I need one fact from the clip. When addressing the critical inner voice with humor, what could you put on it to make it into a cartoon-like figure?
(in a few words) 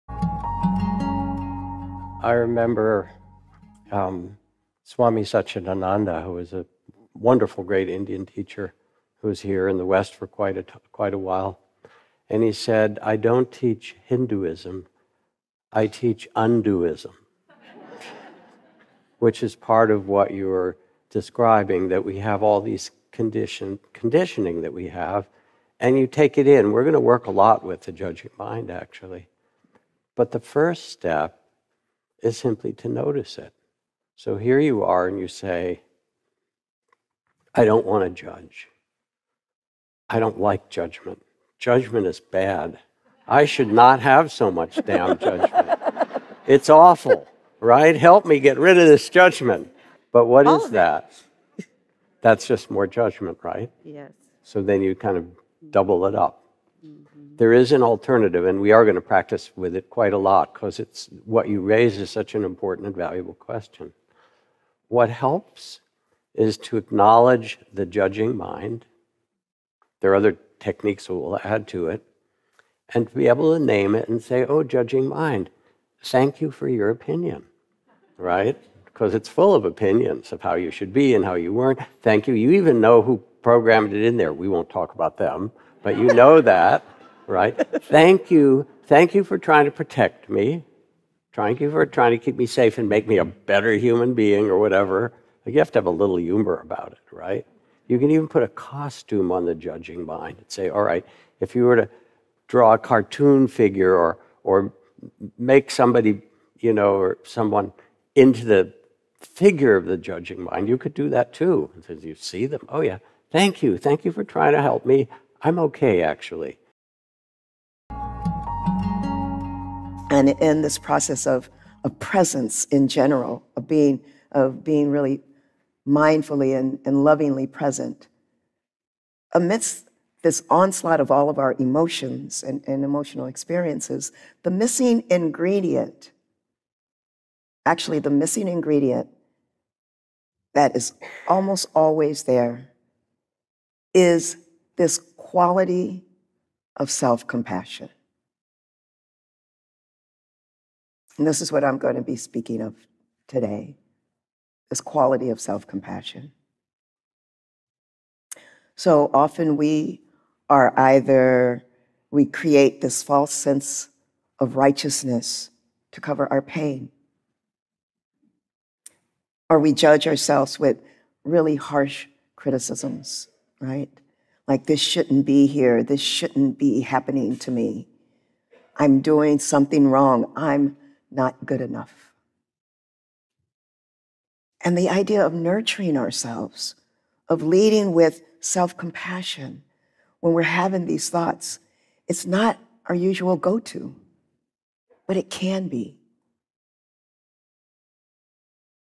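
A costume.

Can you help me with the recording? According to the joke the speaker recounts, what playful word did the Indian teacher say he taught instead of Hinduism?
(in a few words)
Undoism.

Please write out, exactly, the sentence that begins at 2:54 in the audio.
Like, this shouldn't be here, this shouldn't be happening to me.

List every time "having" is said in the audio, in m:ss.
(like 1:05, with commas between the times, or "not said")
3:10.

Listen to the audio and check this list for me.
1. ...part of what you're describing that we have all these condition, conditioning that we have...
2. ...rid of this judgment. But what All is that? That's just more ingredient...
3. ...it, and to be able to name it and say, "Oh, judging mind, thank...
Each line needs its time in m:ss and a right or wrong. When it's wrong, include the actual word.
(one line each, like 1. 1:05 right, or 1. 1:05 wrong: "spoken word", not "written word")
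1. 0:19 right
2. 0:48 wrong: "judgment", not "ingredient"
3. 1:11 right.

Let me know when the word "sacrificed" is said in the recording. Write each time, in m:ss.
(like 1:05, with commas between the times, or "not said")
not said.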